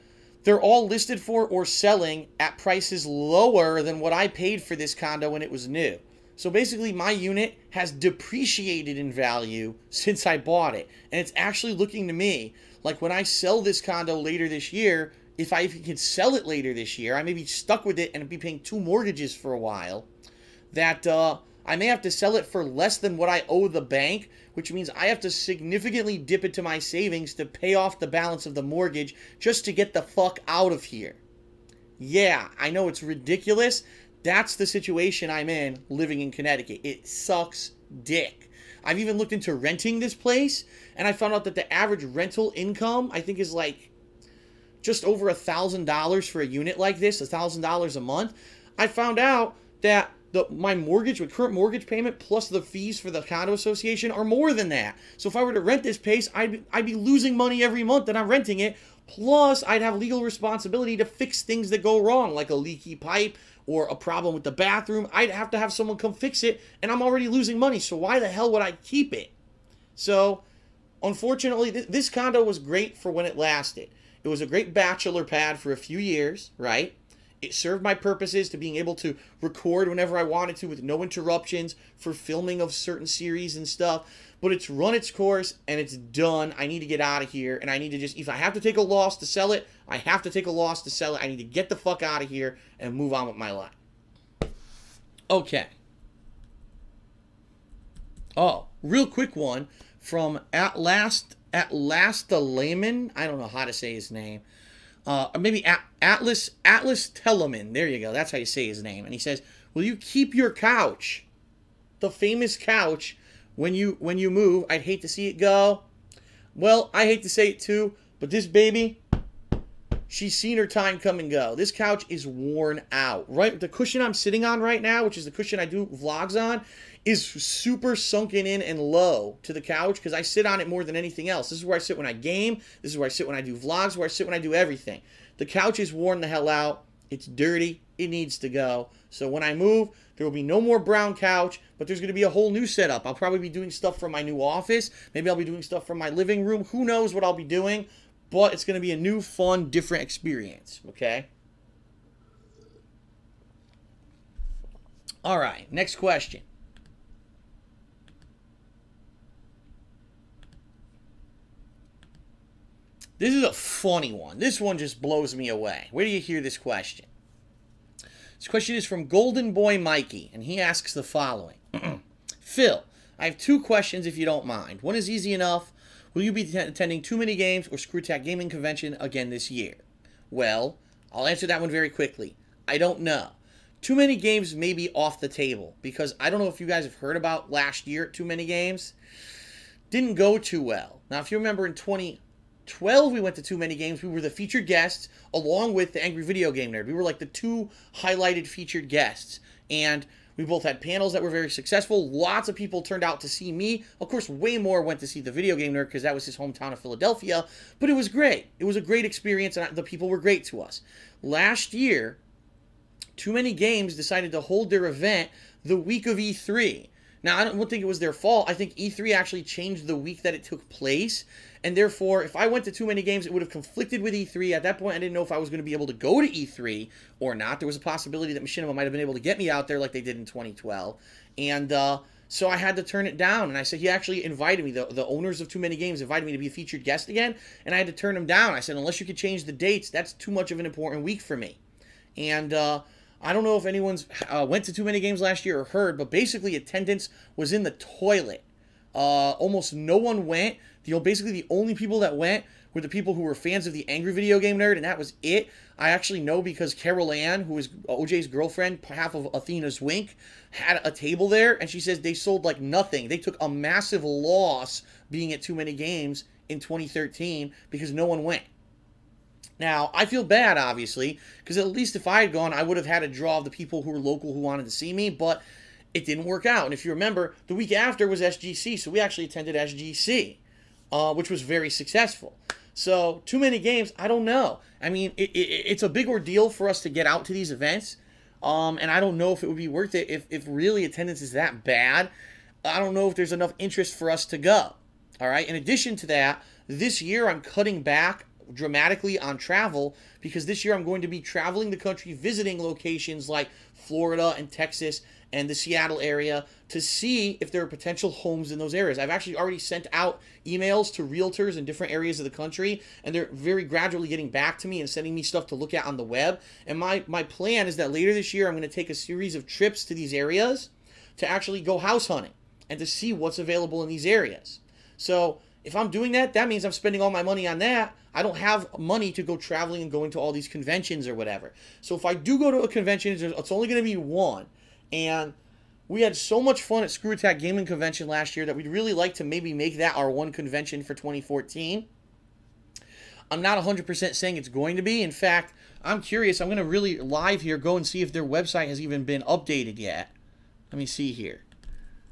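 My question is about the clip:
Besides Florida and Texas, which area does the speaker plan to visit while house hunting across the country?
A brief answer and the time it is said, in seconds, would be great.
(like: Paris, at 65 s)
Seattle, at 305 s.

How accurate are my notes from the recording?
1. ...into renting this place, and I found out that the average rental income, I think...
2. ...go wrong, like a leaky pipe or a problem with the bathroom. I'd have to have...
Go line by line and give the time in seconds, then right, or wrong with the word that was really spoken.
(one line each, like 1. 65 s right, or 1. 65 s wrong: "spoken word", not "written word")
1. 39 s right
2. 61 s right.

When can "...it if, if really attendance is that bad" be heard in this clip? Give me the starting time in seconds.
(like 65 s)
289 s.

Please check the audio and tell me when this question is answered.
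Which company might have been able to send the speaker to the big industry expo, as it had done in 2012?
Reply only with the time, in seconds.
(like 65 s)
228 s.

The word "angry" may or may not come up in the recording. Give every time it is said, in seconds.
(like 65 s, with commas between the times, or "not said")
196 s, 253 s.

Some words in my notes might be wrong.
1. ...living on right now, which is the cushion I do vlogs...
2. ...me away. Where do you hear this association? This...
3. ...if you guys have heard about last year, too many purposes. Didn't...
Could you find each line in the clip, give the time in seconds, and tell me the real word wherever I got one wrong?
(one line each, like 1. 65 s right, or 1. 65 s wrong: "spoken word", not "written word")
1. 124 s wrong: "sitting", not "living"
2. 165 s wrong: "question", not "association"
3. 186 s wrong: "games", not "purposes".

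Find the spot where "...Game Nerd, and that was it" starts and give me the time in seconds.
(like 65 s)
254 s.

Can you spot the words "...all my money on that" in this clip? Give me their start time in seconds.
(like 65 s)
327 s.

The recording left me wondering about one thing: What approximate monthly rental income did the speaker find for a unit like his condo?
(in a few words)
$1,000.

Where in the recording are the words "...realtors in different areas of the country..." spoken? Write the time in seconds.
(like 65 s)
311 s.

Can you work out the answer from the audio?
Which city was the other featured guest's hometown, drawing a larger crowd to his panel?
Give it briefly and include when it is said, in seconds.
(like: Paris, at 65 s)
Philadelphia, at 206 s.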